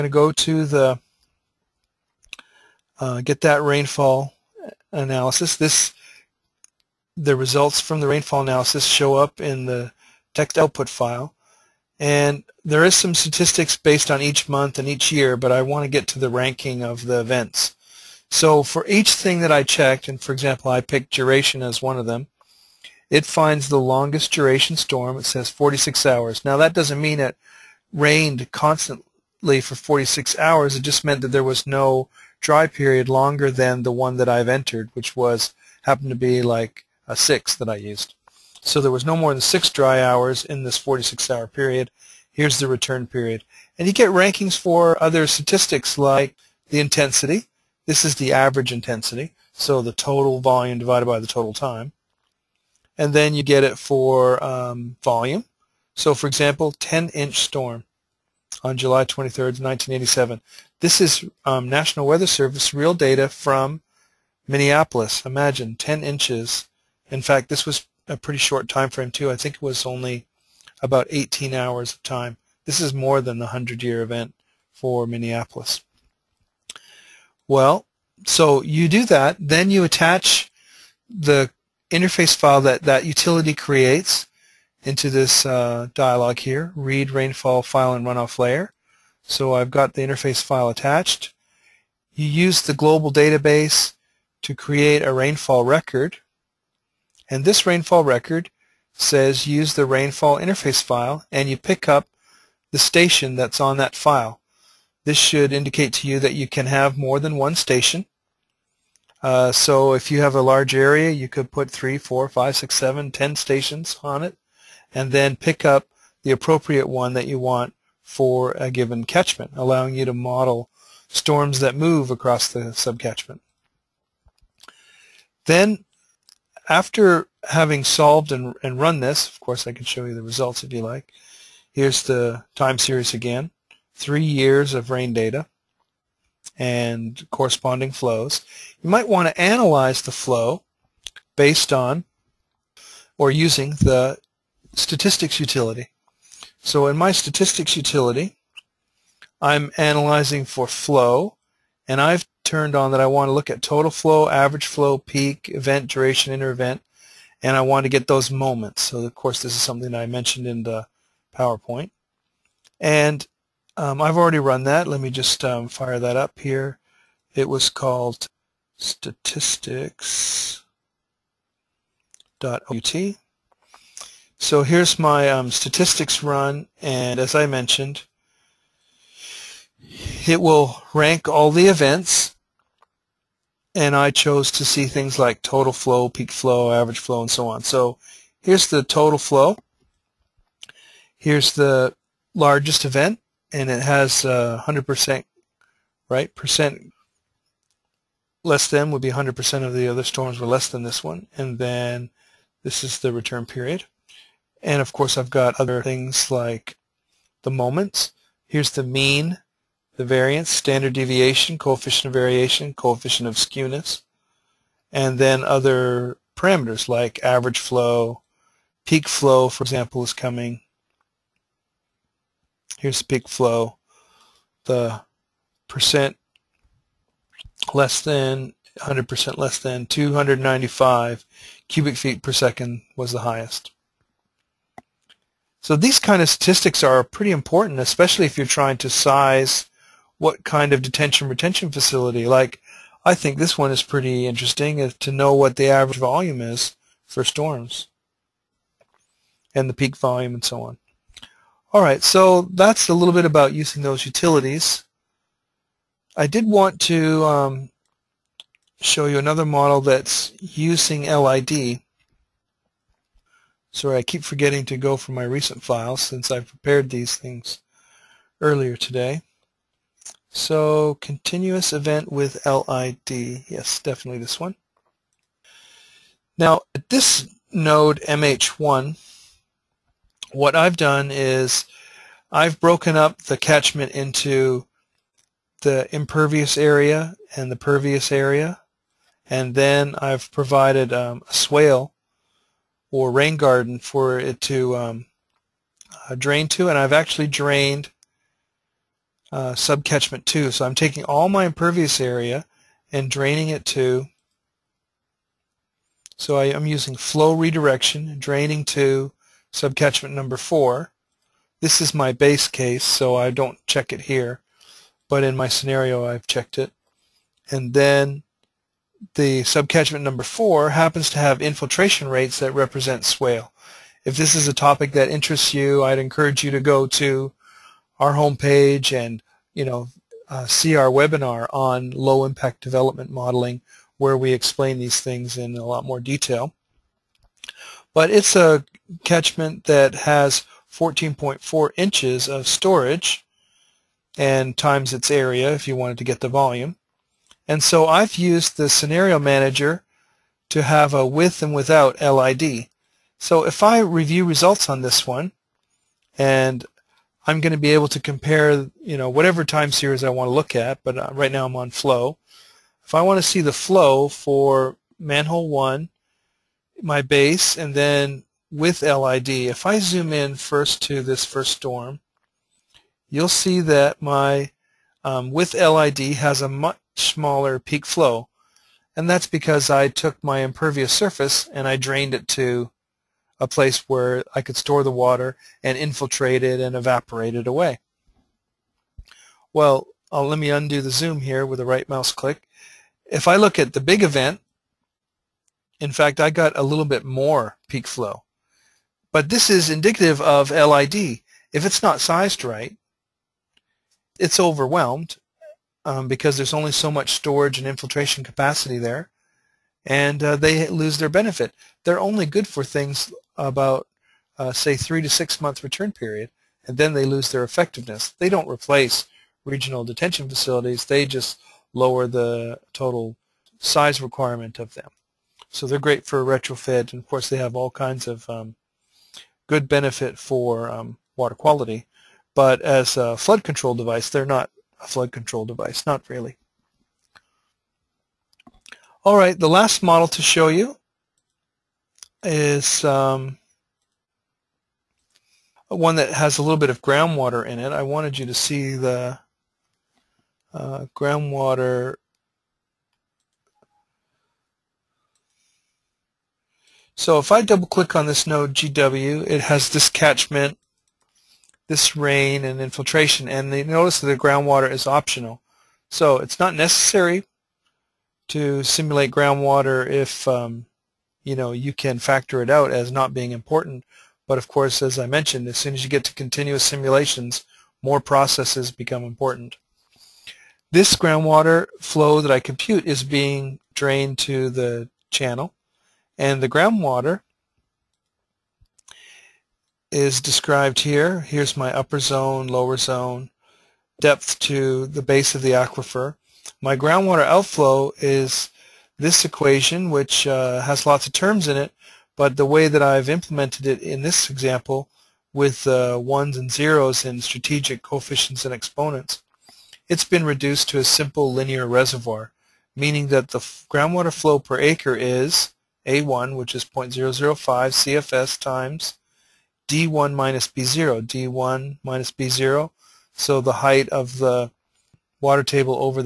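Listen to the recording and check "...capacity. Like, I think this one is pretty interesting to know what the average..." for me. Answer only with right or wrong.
wrong.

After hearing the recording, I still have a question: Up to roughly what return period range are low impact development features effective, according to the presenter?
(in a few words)
3 to 6 months.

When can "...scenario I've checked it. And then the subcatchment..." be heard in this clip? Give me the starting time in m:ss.
5:15.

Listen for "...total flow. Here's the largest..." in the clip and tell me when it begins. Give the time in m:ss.
3:08.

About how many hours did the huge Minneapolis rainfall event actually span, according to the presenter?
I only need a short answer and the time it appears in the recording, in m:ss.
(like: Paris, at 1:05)
18 hours, at 1:11.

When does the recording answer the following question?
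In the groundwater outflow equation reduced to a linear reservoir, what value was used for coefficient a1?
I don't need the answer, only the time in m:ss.
8:36.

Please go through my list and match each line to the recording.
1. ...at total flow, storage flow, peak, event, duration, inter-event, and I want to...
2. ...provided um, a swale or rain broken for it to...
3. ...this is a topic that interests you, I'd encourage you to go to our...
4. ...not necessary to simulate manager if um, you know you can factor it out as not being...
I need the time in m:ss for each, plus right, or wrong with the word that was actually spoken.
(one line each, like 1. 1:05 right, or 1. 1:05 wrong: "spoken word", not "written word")
1. 2:33 wrong: "average", not "storage"
2. 4:50 wrong: "garden", not "broken"
3. 5:24 right
4. 7:46 wrong: "groundwater", not "manager".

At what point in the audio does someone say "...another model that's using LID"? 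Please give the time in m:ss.
4:19.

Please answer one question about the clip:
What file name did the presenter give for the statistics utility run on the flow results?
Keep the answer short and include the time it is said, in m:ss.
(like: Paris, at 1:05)
statistics.ut, at 2:48.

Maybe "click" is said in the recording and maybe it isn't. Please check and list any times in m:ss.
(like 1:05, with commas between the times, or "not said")
6:32, 7:37.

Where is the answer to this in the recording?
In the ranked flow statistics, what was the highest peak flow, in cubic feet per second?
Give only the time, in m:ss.
3:49.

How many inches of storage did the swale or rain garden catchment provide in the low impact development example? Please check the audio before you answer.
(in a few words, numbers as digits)
14.4 inches.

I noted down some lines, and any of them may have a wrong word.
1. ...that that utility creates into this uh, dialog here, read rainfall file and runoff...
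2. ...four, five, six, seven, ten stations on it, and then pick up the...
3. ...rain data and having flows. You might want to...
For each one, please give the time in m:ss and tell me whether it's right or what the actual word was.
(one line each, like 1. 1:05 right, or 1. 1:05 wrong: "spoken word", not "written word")
1. 1:22 right
2. 1:51 right
3. 2:14 wrong: "corresponding", not "having".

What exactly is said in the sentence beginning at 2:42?
And um, I've already run that.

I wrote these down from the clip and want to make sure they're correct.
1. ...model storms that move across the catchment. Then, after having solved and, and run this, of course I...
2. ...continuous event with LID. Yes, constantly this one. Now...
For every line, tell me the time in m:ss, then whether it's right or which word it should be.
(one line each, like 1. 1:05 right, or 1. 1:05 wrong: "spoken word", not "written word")
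1. 2:00 wrong: "subcatchment", not "catchment"
2. 4:31 wrong: "definitely", not "constantly".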